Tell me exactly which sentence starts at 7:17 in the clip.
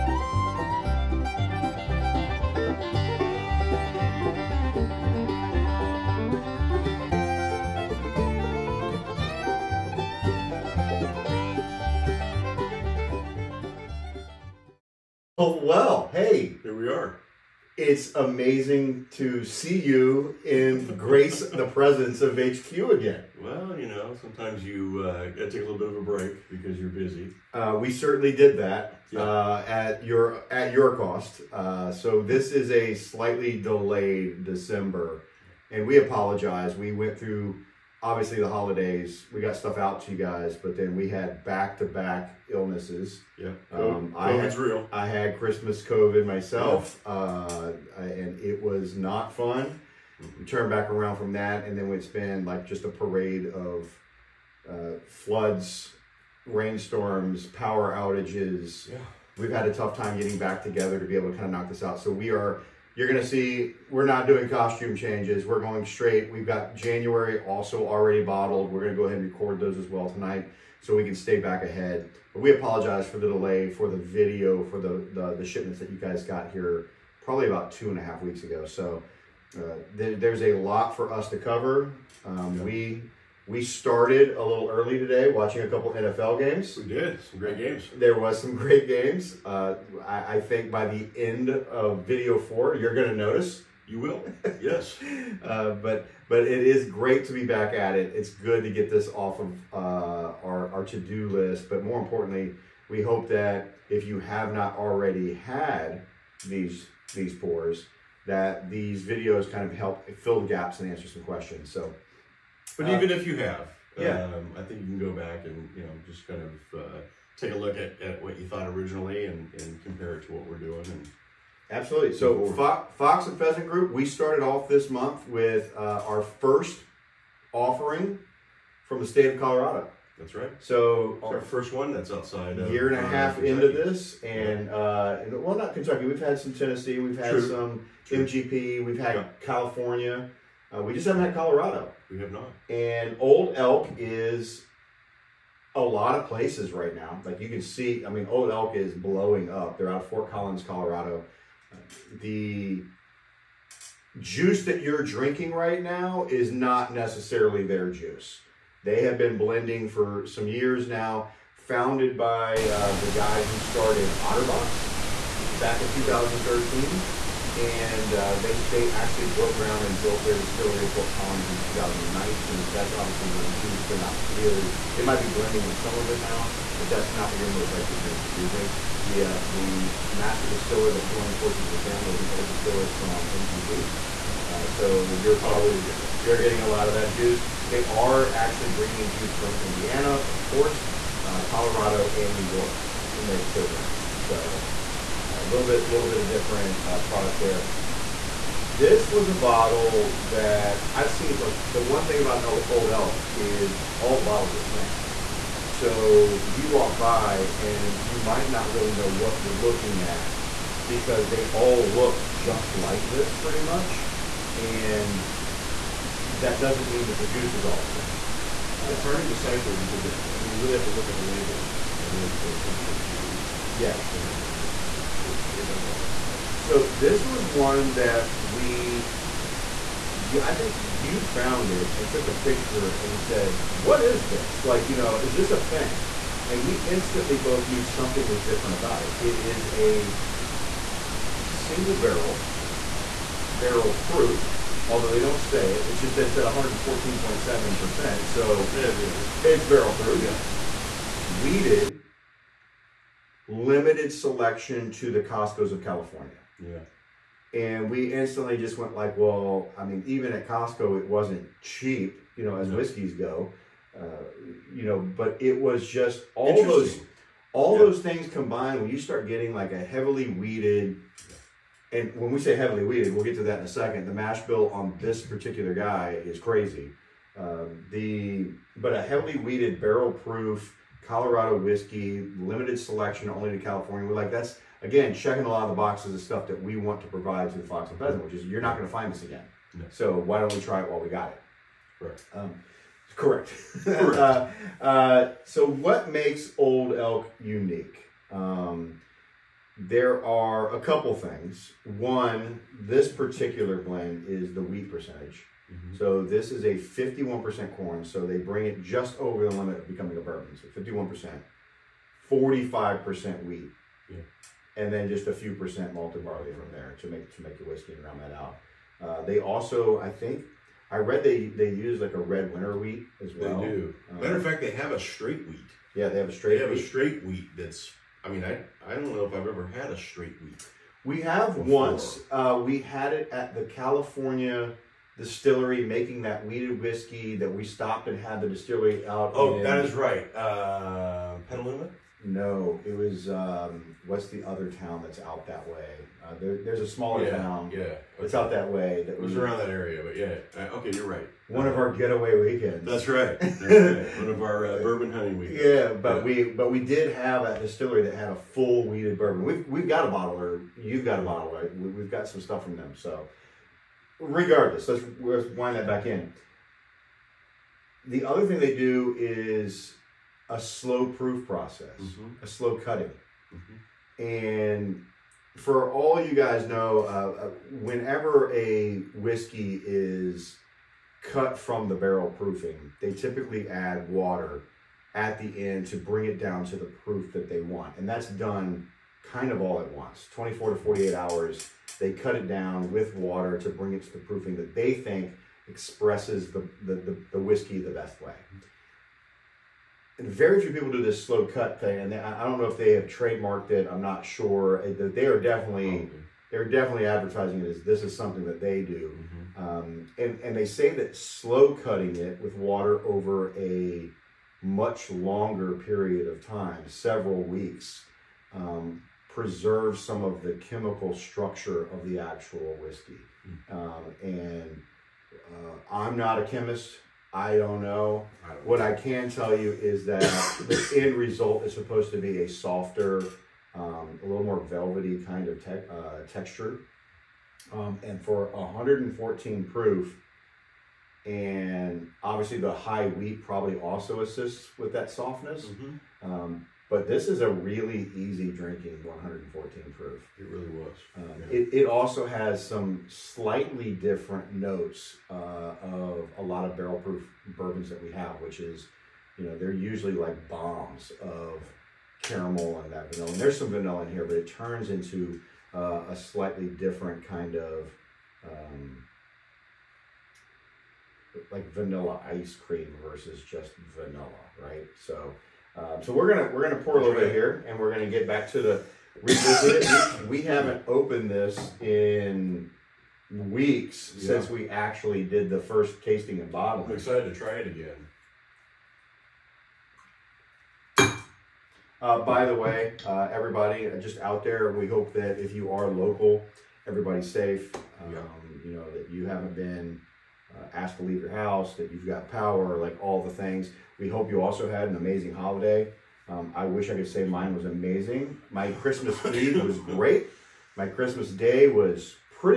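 Um, and for 114 proof, and obviously the high wheat probably also assists with that softness.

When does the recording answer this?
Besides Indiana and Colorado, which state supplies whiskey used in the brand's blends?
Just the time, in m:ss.
3:12.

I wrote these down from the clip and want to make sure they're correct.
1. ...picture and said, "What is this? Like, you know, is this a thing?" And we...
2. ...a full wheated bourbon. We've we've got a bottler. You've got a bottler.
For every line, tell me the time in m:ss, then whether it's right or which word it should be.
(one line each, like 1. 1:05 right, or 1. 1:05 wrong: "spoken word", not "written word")
1. 3:52 right
2. 5:58 right.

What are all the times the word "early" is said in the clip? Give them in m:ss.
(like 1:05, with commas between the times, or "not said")
1:24.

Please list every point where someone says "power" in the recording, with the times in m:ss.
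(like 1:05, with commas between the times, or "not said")
0:57, 8:22.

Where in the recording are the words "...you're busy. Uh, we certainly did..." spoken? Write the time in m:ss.
0:26.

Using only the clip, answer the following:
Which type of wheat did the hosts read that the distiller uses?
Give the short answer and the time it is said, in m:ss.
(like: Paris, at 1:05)
red winter wheat, at 5:22.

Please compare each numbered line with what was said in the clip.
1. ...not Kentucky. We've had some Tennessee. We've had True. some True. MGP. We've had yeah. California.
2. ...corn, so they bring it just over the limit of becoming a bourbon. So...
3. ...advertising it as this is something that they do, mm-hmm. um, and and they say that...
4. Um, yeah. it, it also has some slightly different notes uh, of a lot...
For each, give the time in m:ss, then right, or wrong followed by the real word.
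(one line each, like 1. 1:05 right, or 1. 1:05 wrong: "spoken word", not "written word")
1. 2:15 right
2. 5:07 right
3. 6:47 right
4. 7:31 right.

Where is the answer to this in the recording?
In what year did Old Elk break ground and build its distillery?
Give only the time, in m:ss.
2:51.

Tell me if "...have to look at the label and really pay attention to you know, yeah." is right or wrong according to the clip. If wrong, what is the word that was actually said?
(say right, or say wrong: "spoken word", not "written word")
right.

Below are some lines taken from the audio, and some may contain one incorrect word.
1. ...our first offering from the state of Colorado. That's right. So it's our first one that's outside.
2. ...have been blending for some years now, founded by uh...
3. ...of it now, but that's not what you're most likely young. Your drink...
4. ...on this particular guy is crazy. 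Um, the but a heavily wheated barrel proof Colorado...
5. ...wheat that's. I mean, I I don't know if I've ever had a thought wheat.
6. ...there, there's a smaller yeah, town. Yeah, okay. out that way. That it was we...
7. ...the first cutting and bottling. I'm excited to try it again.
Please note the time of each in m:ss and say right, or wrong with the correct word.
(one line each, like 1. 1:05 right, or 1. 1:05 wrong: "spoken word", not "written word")
1. 2:06 right
2. 2:39 right
3. 2:55 wrong: "drinking", not "young"
4. 4:34 right
5. 5:27 wrong: "straight", not "thought"
6. 5:46 right
7. 8:05 wrong: "tasting", not "cutting".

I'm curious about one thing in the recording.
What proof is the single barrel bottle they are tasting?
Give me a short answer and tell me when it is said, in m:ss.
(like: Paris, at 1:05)
114.7, at 4:06.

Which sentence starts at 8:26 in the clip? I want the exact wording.
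Um, I wish I could say mine was amazing.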